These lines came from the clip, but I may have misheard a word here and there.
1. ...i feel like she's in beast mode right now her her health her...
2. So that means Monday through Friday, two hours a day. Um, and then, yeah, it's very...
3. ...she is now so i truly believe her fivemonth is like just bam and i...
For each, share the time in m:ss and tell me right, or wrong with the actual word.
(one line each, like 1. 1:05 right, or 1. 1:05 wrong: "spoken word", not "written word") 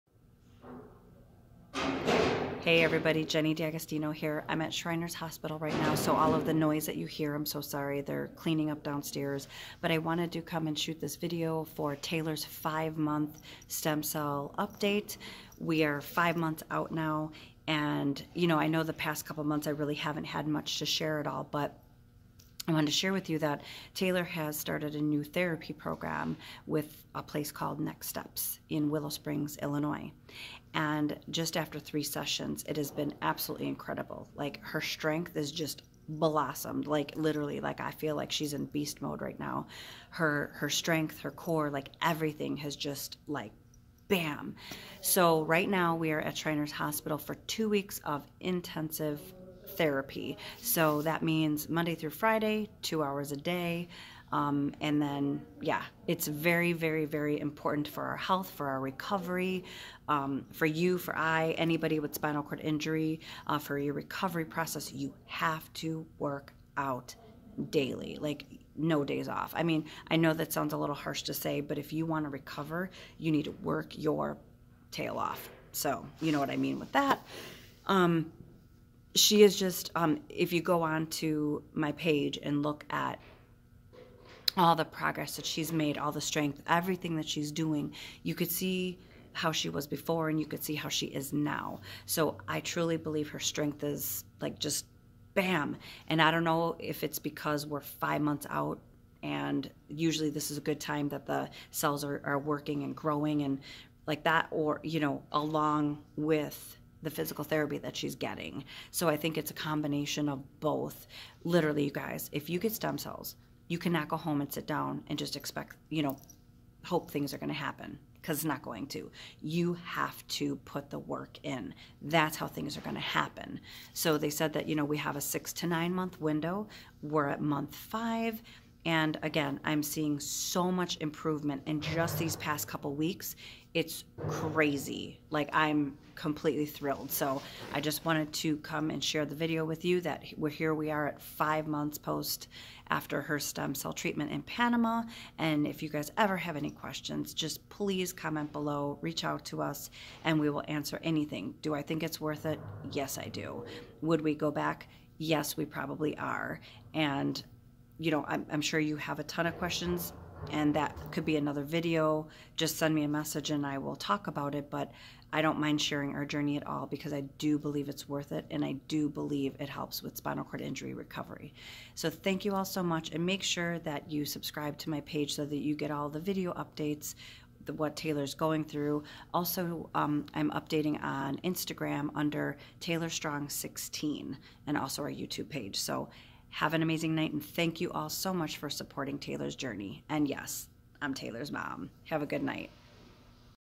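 1. 0:37 wrong: "strength", not "health"
2. 0:50 right
3. 1:30 wrong: "strength", not "fivemonth".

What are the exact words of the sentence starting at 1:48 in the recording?
So I think it's a combination of both.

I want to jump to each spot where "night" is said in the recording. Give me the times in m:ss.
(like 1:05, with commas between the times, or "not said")
3:07, 3:12.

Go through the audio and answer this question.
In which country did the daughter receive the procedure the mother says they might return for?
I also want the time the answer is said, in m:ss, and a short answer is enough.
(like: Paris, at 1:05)
Panama, at 2:24.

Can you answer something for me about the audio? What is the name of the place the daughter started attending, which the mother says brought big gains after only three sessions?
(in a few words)
Next Steps.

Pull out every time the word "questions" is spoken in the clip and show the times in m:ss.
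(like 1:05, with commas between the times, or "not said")
2:26, 2:39.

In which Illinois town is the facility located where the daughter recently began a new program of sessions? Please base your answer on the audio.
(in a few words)
Willow Springs.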